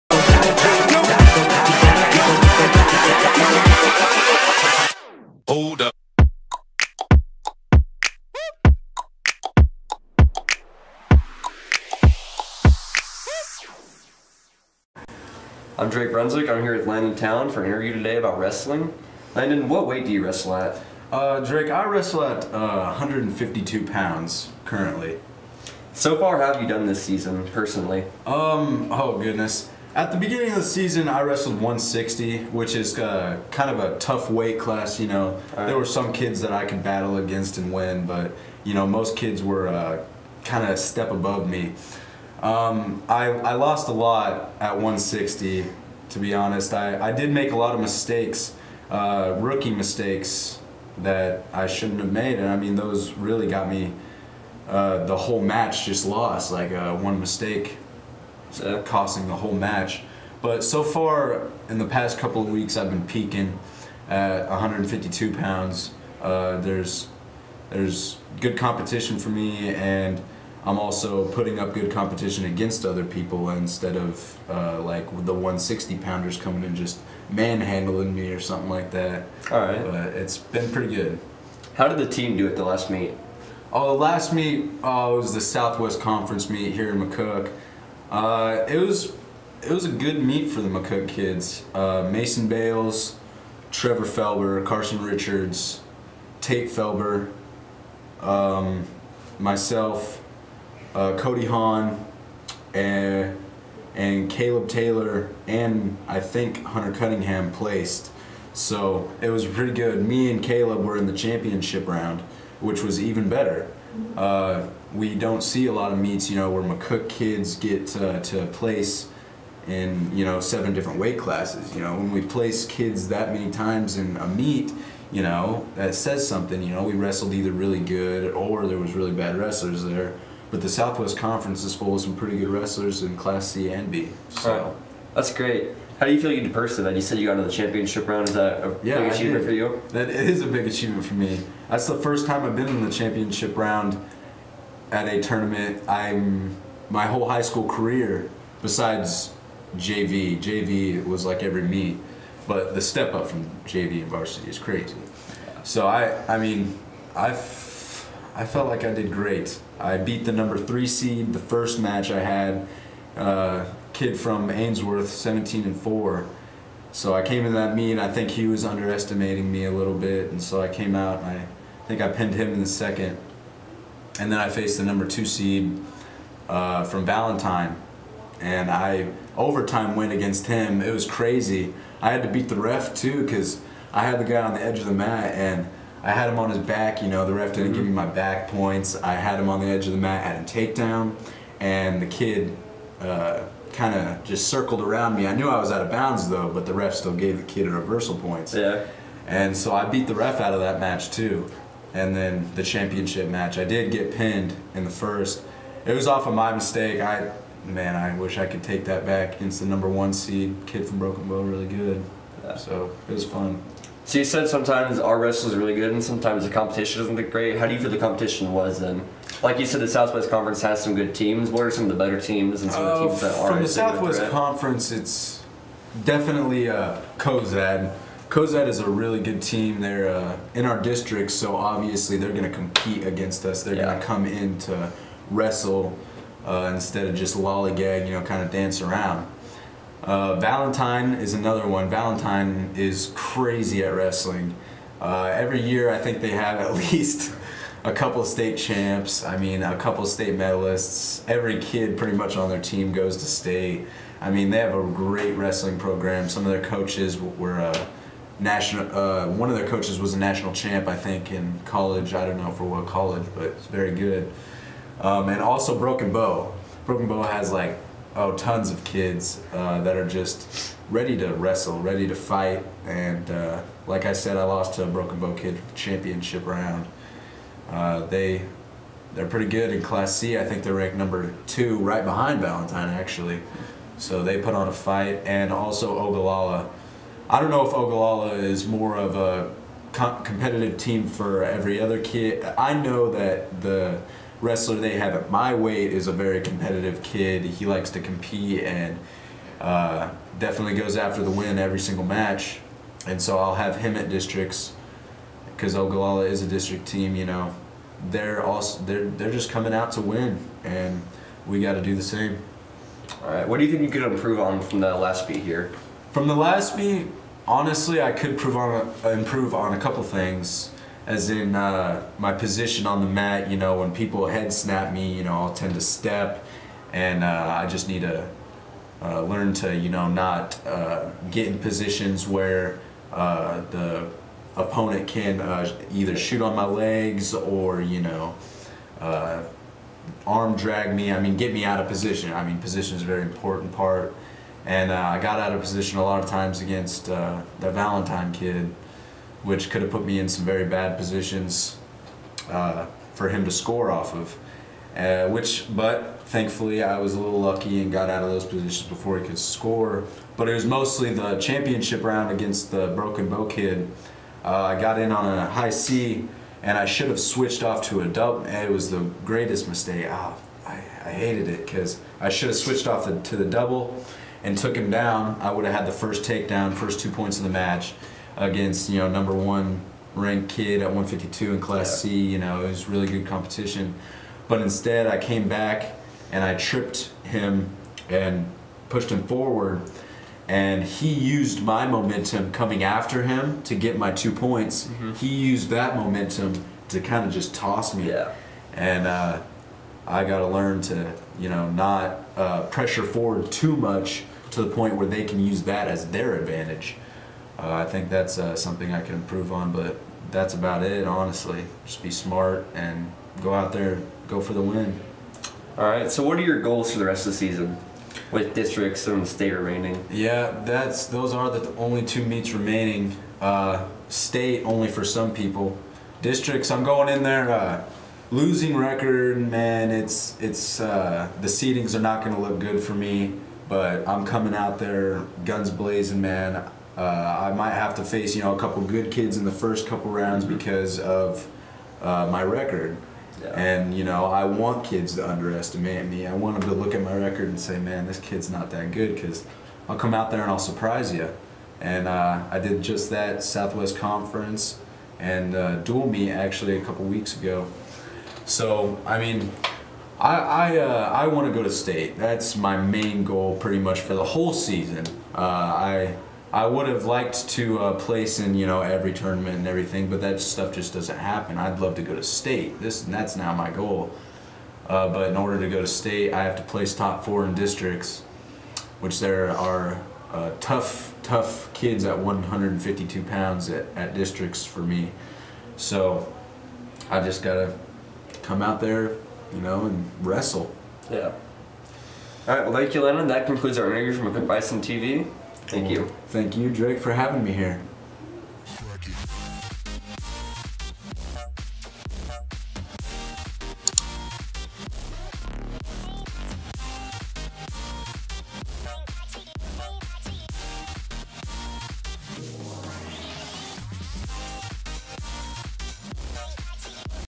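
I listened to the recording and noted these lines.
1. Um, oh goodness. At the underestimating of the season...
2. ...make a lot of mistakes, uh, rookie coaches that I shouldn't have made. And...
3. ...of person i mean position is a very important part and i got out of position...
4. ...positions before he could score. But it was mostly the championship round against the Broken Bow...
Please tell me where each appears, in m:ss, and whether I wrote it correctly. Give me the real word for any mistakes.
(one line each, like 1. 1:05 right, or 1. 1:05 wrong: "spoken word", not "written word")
1. 0:28 wrong: "beginning", not "underestimating"
2. 0:47 wrong: "mistakes", not "coaches"
3. 5:41 wrong: "position", not "person"
4. 5:58 right.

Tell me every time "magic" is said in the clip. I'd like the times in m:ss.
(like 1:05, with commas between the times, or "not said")
not said.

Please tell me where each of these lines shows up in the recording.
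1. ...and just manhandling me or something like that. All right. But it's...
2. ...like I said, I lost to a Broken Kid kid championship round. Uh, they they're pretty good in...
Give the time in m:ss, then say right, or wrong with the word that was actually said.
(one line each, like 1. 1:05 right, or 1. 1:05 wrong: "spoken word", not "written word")
1. 1:16 right
2. 4:33 wrong: "Bow", not "Kid".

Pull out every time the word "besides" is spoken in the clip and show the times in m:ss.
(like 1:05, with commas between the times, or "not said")
2:28.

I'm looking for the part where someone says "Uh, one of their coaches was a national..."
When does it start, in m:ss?
4:18.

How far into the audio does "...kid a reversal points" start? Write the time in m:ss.
3:17.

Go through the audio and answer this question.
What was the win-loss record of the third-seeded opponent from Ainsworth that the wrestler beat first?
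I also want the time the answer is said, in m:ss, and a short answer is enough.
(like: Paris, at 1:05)
17 and 4, at 2:45.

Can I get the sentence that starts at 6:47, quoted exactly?
Uh, I think that's uh, something I can improve on, but that's about it, honestly.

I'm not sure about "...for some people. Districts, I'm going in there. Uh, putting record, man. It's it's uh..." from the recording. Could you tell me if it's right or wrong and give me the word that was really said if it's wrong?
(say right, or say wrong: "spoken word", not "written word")
wrong: "losing", not "putting".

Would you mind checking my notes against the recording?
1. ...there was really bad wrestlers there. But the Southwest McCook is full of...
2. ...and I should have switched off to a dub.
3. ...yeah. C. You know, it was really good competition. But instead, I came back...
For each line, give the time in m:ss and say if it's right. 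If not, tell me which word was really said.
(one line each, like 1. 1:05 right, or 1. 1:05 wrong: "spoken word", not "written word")
1. 2:08 wrong: "Conference", not "McCook"
2. 6:06 right
3. 6:22 right.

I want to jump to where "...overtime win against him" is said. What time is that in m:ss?
2:59.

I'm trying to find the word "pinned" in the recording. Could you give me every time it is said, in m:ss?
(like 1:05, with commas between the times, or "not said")
2:52, 3:24.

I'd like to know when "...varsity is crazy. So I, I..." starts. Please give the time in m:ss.
2:34.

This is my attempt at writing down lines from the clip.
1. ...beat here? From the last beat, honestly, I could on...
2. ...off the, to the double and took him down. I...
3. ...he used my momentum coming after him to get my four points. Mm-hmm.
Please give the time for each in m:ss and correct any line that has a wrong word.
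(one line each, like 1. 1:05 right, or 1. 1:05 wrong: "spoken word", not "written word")
1. 5:15 right
2. 6:12 right
3. 6:30 wrong: "two", not "four".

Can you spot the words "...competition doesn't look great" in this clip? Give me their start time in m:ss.
3:36.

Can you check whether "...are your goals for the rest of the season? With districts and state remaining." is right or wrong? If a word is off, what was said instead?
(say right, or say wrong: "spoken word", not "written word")
right.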